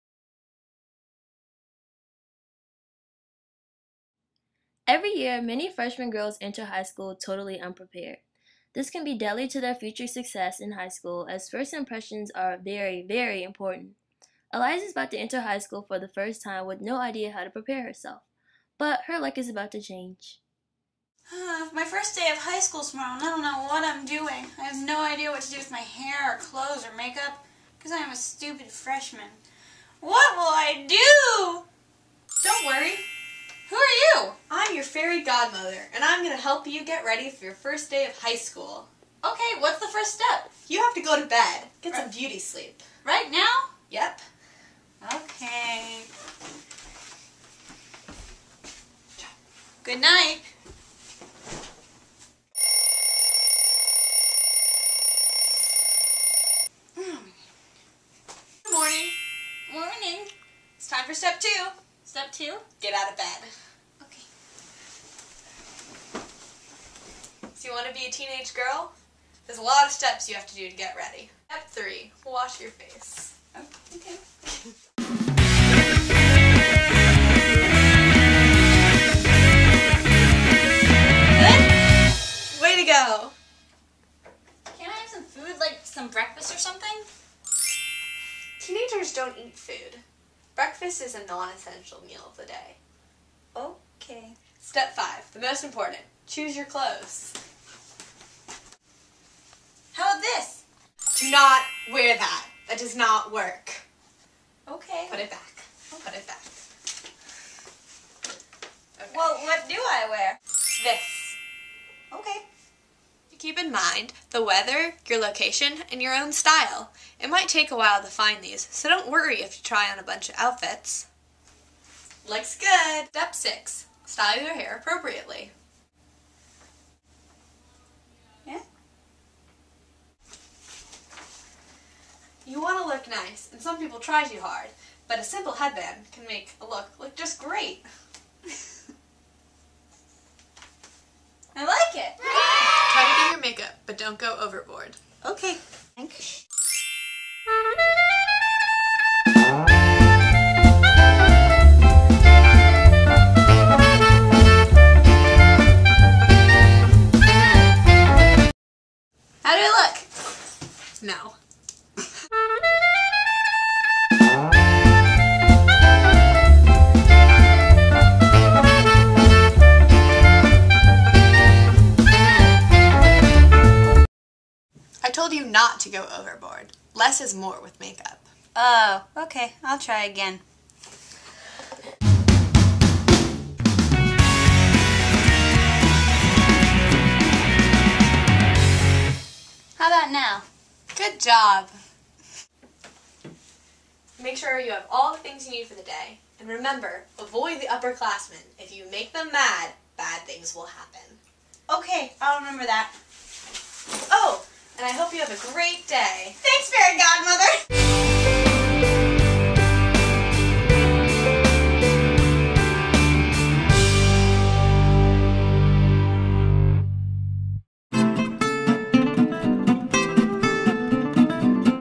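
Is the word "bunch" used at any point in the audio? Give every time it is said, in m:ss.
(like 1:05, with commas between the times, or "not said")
2:00.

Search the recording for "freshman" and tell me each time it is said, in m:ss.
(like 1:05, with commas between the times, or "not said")
0:05, 0:28.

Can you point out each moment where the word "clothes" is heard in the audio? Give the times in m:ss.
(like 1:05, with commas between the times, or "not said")
0:26, 1:36.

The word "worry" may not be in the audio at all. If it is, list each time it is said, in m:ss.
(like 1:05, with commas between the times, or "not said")
0:32, 1:59.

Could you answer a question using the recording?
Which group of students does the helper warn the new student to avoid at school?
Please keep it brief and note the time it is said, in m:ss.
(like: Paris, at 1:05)
The upperclassmen, at 3:17.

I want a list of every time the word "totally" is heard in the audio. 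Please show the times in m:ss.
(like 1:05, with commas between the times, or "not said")
0:07.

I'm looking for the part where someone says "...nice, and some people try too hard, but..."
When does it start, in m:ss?
2:13.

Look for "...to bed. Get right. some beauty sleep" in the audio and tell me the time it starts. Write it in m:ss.
0:41.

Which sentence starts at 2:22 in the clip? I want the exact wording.
Try to do your makeup, but don't go overboard.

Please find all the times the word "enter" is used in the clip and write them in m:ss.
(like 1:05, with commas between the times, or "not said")
0:06, 0:15.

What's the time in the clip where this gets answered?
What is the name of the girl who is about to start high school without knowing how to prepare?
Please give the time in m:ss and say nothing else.
0:14.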